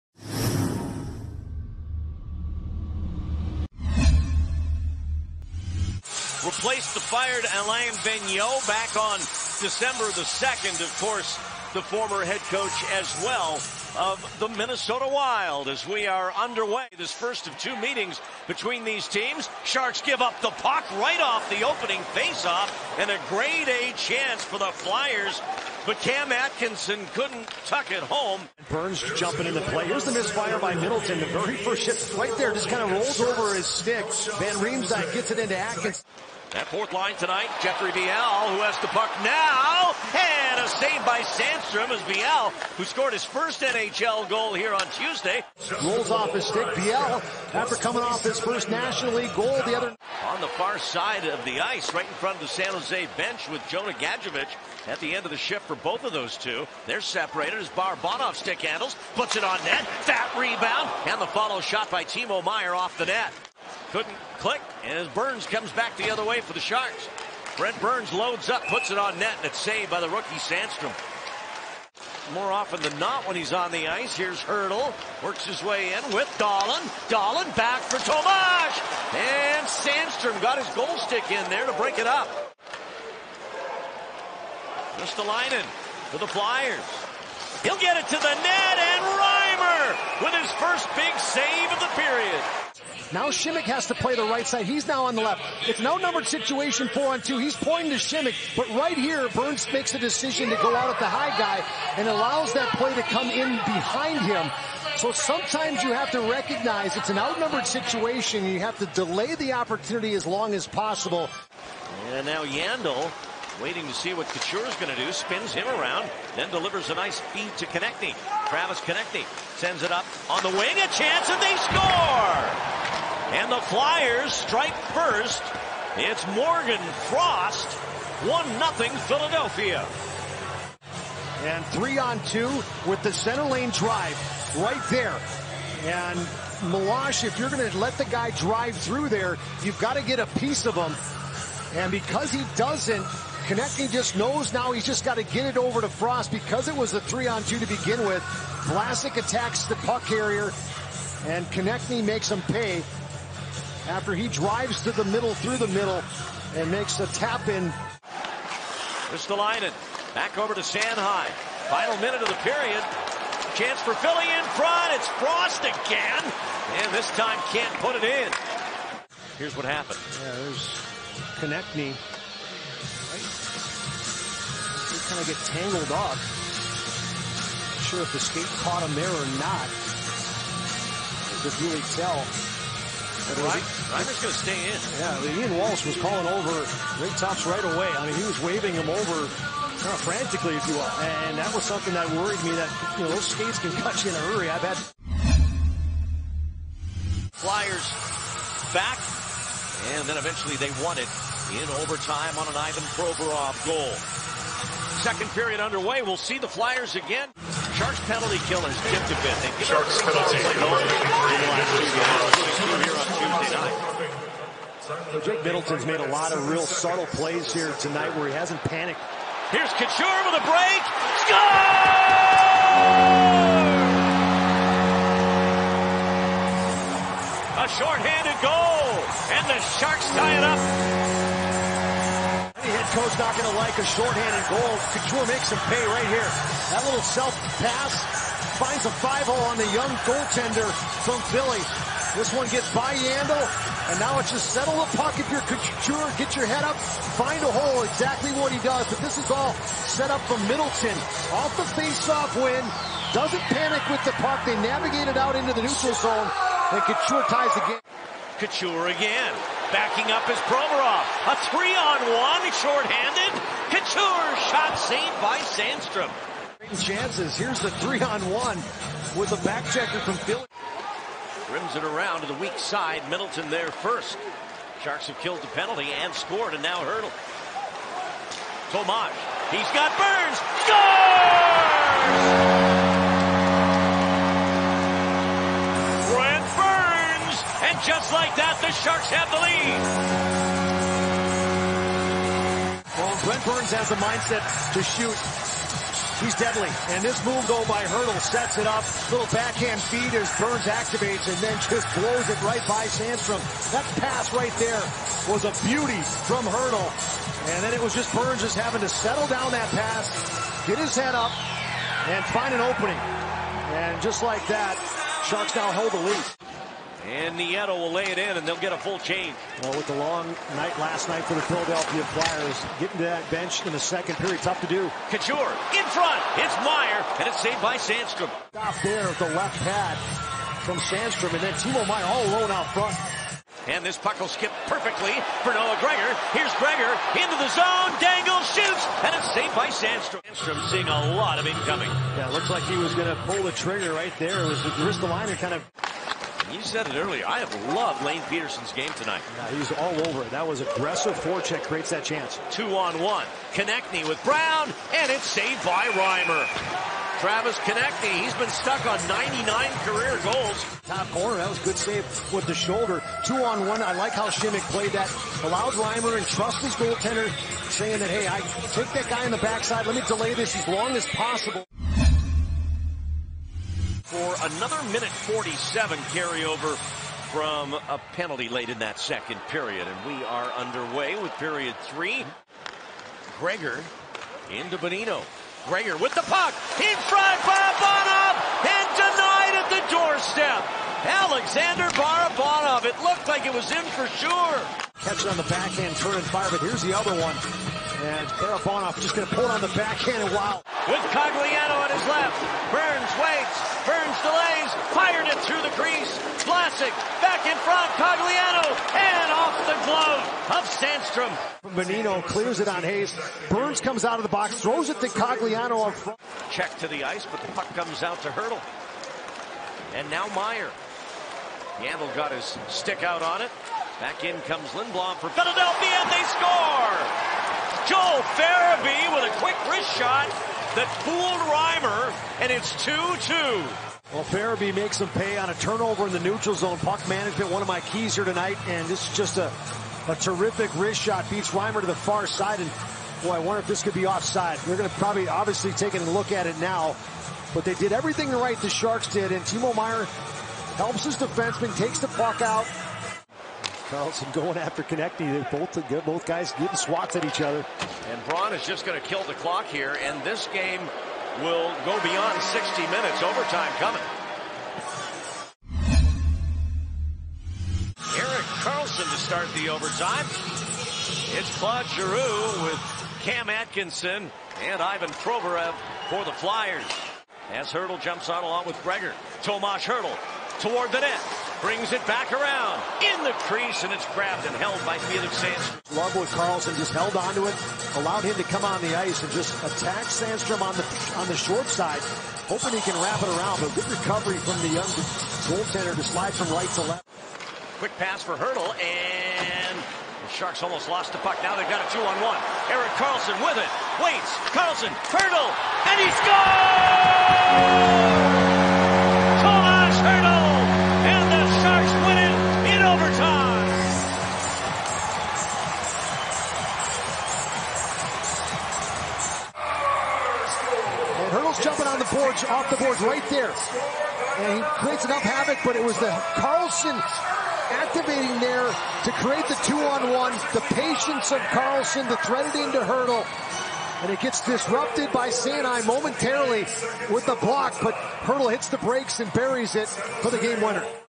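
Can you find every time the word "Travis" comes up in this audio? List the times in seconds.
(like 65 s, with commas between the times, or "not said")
118 s, 357 s.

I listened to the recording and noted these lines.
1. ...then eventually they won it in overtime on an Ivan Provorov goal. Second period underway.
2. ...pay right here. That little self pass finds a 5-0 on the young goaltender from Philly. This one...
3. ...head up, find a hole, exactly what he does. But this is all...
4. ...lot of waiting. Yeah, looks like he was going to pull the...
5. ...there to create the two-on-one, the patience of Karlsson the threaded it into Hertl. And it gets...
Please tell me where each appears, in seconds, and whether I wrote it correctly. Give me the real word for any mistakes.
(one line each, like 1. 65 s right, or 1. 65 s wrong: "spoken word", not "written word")
1. 200 s right
2. 235 s right
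3. 246 s right
4. 341 s wrong: "incoming", not "waiting"
5. 528 s right.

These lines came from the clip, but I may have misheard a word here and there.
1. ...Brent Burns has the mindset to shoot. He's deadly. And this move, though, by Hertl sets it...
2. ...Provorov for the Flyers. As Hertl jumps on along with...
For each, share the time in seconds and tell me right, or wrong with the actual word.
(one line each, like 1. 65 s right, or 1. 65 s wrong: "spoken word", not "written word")
1. 293 s right
2. 475 s right.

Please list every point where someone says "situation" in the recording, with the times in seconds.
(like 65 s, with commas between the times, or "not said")
96 s, 107 s.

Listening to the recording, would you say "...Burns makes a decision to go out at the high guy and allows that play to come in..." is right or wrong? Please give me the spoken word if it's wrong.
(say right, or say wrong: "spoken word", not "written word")
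right.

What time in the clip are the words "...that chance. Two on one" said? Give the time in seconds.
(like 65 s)
351 s.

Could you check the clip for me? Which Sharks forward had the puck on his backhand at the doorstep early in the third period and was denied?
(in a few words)
Alexander Barabanov.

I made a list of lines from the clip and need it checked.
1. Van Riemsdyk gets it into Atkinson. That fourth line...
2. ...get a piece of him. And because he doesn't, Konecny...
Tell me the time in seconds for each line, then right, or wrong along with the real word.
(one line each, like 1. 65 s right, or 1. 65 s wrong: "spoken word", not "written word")
1. 34 s right
2. 140 s right.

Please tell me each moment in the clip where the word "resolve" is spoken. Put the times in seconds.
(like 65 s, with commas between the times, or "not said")
not said.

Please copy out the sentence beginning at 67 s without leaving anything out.
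Brent Burns loads up, puts it on net, and it's saved by the rookie Sandstrom.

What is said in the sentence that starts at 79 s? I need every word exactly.
And Sandstrom got his goal stick in there to break it up.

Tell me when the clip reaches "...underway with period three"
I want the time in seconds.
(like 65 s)
380 s.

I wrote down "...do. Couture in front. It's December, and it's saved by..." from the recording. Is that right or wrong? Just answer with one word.
wrong.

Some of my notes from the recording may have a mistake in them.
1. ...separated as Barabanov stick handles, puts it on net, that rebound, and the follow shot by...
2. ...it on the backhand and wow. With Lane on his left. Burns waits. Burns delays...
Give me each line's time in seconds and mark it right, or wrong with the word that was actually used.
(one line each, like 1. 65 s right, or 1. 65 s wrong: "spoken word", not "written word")
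1. 57 s right
2. 399 s wrong: "Cogliano", not "Lane".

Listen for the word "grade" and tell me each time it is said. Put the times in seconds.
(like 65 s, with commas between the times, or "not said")
23 s.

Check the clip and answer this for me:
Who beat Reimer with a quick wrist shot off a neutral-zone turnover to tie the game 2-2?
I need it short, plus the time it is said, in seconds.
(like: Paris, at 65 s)
Joel Farabee, at 427 s.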